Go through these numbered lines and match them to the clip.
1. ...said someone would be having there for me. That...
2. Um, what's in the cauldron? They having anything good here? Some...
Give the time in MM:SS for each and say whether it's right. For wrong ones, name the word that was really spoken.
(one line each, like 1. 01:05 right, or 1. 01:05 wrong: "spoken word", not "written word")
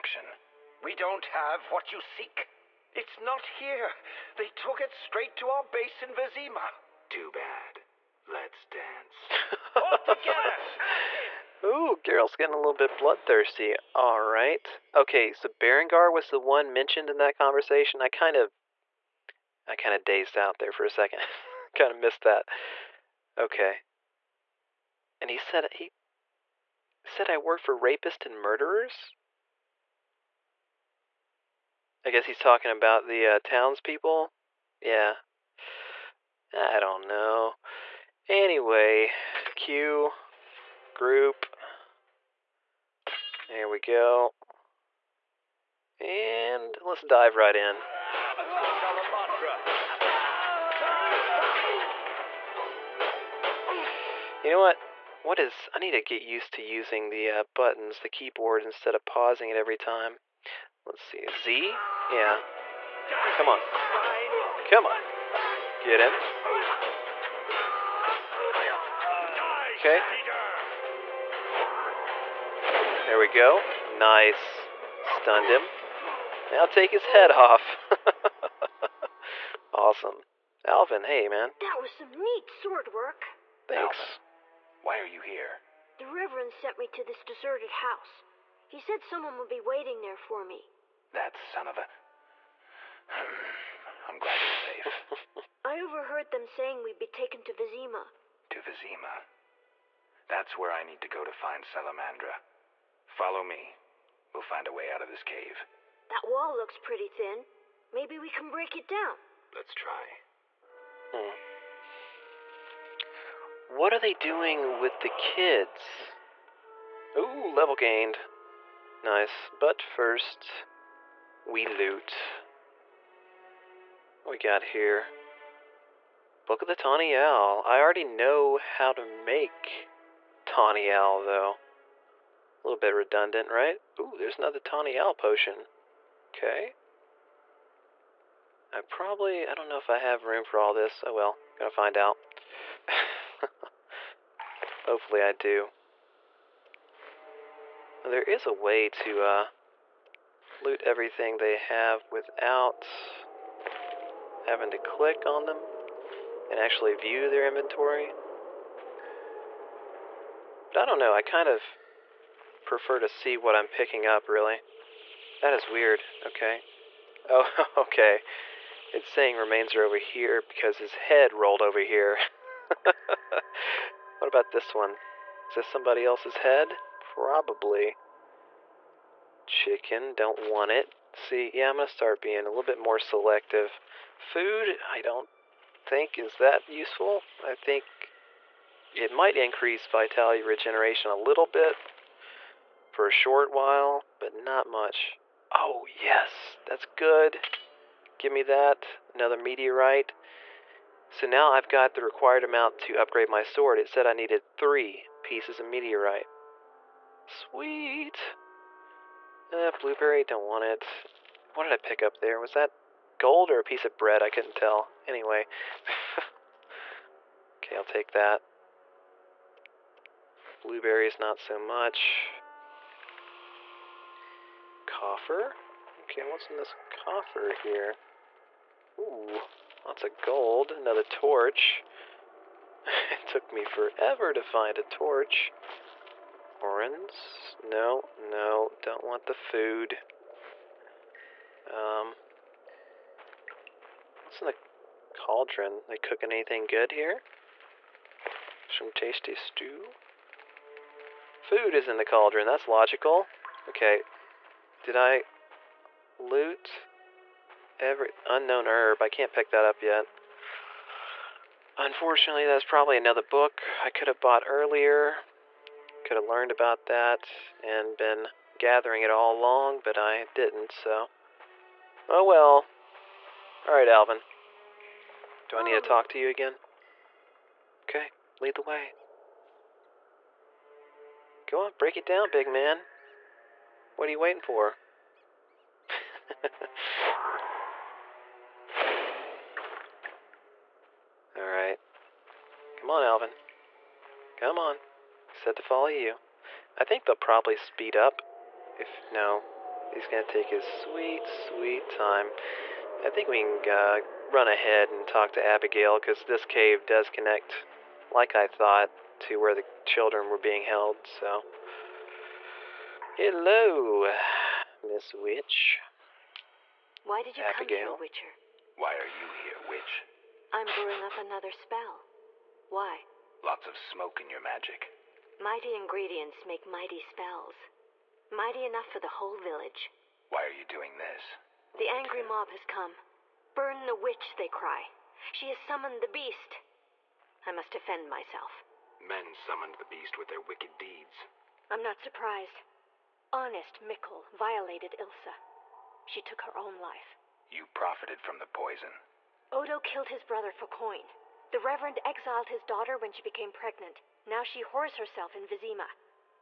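1. 01:28 wrong: "waiting", not "having"
2. 04:01 wrong: "cooking", not "having".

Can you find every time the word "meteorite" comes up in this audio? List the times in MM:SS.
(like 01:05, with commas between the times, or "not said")
03:19, 03:25.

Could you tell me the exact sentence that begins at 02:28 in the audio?
Well, there is a way to uh, loot everything they have without having to click on them and actually view their inventory.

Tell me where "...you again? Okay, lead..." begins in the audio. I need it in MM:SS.
04:36.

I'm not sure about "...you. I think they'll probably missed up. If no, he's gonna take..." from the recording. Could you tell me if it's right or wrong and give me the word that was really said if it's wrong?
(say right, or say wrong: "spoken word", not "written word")
wrong: "speed", not "missed".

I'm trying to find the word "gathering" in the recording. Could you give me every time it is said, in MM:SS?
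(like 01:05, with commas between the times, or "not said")
04:28.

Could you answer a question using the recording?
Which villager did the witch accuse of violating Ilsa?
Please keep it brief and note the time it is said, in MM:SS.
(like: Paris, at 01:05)
Mikul, at 05:43.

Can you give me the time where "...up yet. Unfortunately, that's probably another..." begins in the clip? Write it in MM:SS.
04:19.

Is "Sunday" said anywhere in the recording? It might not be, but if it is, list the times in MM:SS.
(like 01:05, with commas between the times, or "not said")
not said.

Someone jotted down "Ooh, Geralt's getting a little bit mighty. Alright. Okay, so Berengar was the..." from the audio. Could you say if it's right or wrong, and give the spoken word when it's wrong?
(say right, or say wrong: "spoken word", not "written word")
wrong: "bloodthirsty", not "mighty".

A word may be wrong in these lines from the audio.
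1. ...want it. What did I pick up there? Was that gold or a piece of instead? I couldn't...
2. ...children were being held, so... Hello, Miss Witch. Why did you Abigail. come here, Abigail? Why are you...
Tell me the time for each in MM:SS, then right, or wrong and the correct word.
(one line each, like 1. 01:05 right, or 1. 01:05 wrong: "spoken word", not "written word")
1. 03:30 wrong: "bread", not "instead"
2. 05:09 wrong: "Witcher", not "Abigail".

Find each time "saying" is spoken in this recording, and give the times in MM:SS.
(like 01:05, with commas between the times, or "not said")
01:36, 02:49.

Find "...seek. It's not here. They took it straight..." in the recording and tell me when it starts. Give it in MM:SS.
00:02.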